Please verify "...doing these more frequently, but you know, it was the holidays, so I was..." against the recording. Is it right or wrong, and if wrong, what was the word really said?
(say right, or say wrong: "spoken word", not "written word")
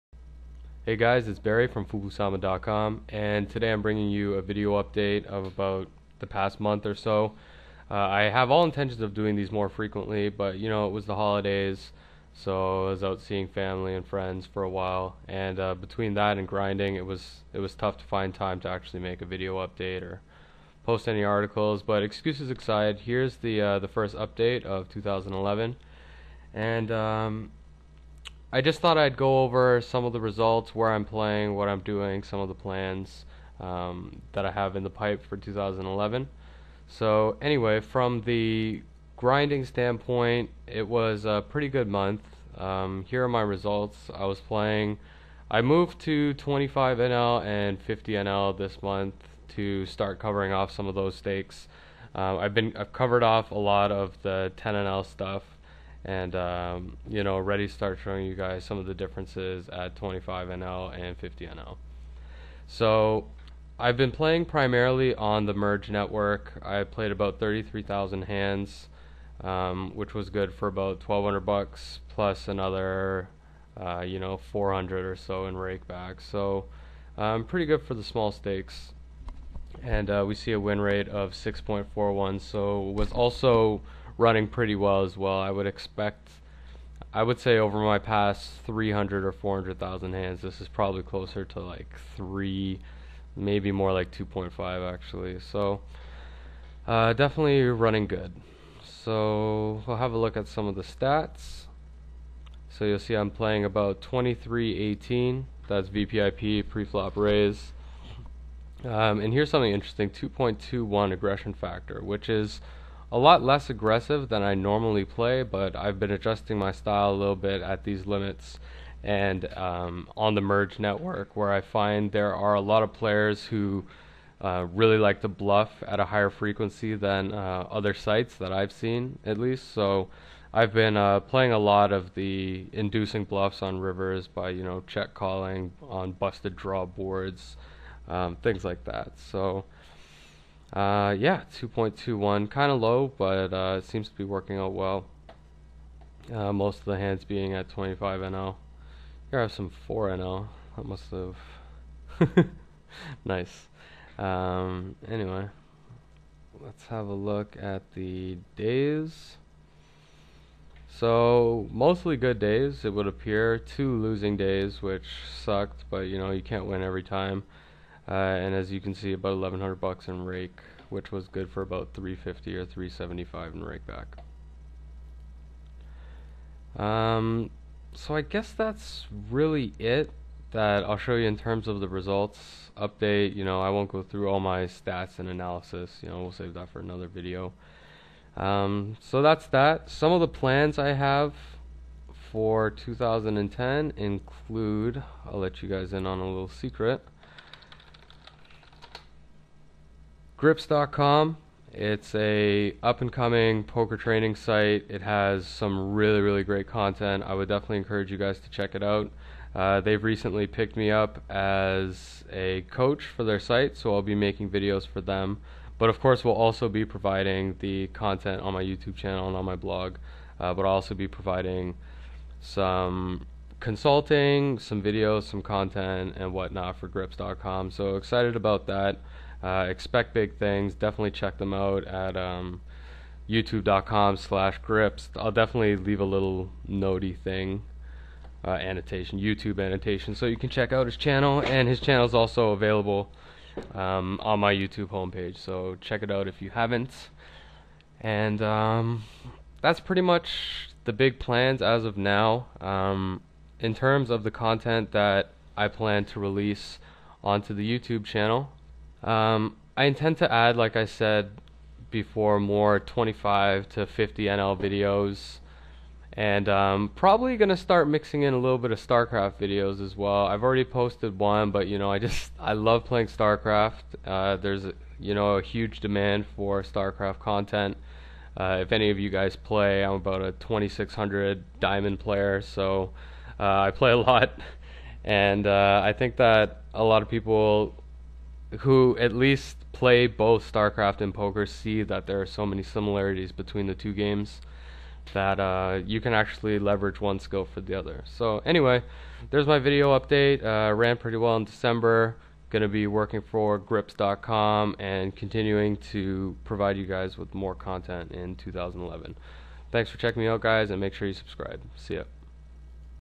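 right.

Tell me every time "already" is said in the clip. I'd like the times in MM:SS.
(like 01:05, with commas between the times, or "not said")
00:57, 04:30.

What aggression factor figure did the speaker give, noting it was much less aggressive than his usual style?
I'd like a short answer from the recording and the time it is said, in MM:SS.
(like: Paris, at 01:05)
2.21, at 01:50.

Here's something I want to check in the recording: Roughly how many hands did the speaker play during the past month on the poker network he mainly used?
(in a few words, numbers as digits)
33,000.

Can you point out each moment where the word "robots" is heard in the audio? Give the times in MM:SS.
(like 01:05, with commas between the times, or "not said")
not said.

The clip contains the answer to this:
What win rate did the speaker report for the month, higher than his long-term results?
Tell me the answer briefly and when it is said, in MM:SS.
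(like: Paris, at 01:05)
6.41, at 01:21.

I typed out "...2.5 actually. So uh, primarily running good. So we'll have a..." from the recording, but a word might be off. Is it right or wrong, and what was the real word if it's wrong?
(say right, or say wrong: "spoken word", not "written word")
wrong: "definitely", not "primarily".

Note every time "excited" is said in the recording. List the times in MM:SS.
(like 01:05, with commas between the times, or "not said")
03:47.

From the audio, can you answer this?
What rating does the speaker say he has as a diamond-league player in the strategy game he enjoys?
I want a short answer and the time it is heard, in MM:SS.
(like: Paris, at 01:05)
2600, at 04:40.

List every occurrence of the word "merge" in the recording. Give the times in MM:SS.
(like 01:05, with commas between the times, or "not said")
01:05, 02:00.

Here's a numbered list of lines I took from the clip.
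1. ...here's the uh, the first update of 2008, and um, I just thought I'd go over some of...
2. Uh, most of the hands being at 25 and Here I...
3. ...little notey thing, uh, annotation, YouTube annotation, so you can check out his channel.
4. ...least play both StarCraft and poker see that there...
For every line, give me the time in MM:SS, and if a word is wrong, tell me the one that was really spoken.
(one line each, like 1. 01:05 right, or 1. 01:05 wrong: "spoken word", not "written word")
1. 00:23 wrong: "2011", not "2008"
2. 02:26 right
3. 03:56 right
4. 04:49 right.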